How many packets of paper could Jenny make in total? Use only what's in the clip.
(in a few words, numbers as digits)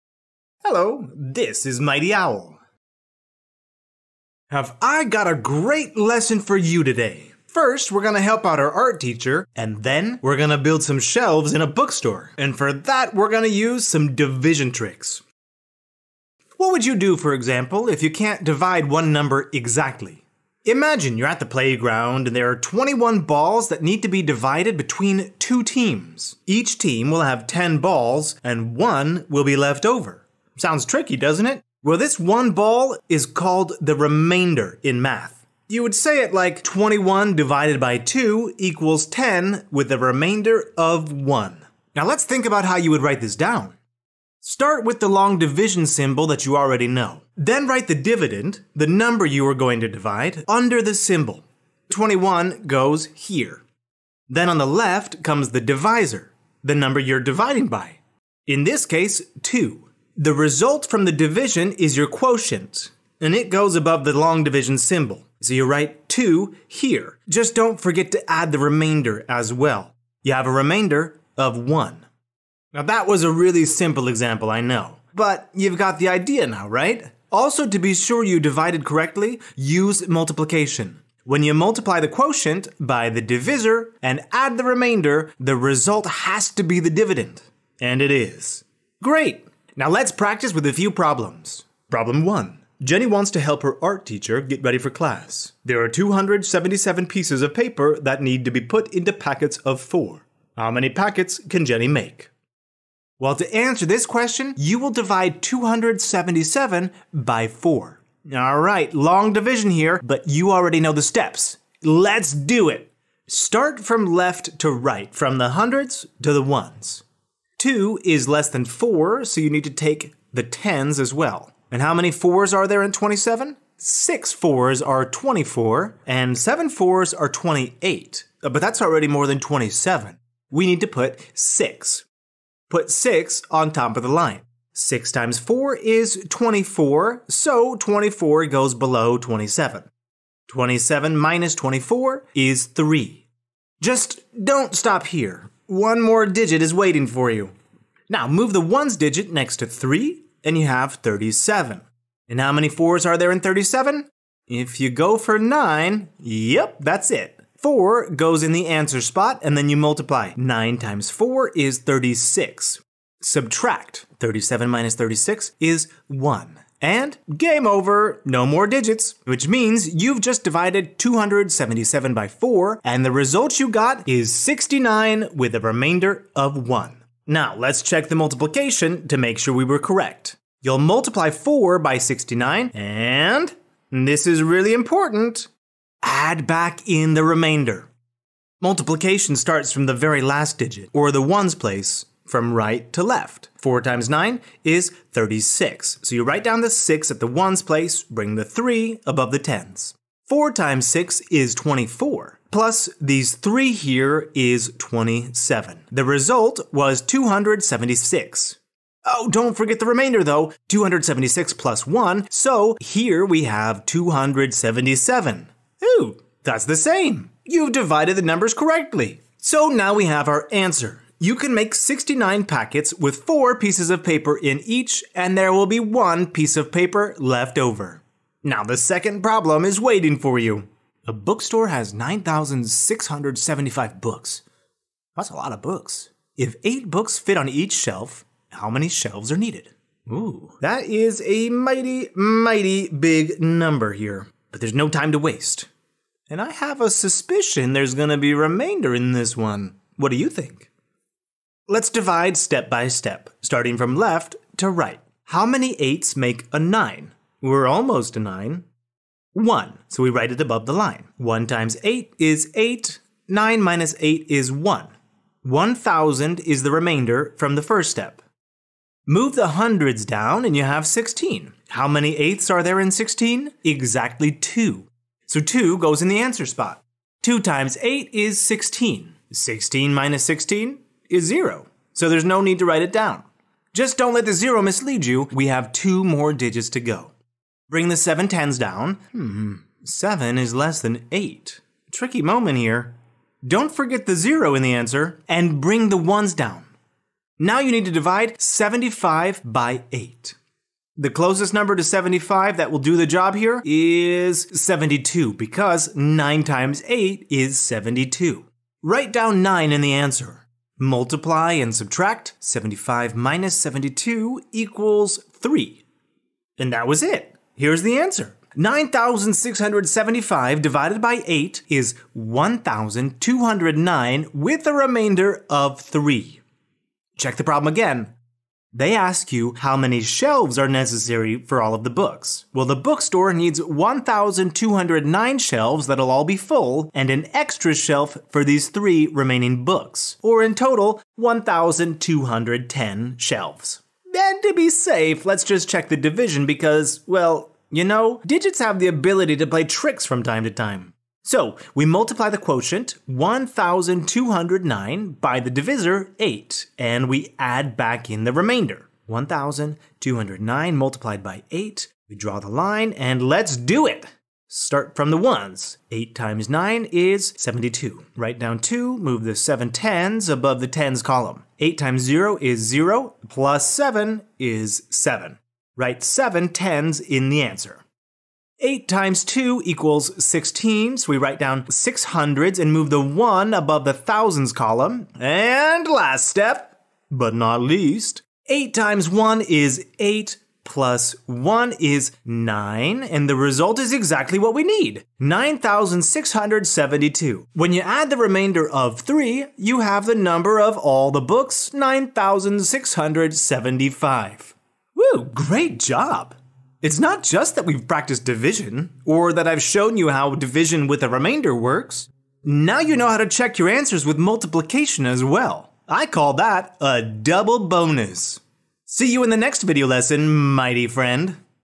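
69.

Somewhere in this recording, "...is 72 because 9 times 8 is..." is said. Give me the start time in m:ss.
5:03.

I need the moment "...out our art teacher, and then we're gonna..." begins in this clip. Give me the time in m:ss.
0:08.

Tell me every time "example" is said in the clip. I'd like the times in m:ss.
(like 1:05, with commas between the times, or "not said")
0:17, 1:14.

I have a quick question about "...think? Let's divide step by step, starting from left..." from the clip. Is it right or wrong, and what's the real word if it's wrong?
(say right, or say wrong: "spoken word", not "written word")
right.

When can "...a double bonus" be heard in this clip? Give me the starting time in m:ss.
6:56.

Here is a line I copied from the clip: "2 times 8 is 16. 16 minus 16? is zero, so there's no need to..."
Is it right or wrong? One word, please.
right.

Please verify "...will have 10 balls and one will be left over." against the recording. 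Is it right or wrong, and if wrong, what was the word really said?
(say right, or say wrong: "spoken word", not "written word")
right.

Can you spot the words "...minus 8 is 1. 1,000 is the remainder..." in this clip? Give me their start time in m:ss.
4:23.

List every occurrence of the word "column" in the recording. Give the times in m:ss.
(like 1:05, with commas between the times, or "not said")
6:11, 6:24.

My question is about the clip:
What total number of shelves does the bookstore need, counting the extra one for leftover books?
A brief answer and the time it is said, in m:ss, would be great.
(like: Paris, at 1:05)
1,210, at 5:41.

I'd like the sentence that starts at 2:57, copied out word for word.
Now, let's check the multiplication to make sure we were correct.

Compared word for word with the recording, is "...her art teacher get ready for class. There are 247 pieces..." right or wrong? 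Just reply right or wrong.
wrong.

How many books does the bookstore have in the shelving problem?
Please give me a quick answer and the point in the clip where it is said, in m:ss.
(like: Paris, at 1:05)
9,675, at 3:51.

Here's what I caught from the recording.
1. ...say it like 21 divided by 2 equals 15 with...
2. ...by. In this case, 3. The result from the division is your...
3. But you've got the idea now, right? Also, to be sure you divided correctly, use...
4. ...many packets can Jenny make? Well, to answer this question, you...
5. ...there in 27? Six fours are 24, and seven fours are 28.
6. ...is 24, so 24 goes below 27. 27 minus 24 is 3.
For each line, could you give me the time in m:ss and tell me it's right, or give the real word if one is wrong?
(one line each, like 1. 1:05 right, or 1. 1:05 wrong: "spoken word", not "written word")
1. 0:35 wrong: "10", not "15"
2. 0:57 wrong: "2", not "3"
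3. 1:15 right
4. 1:40 right
5. 2:02 right
6. 2:15 right.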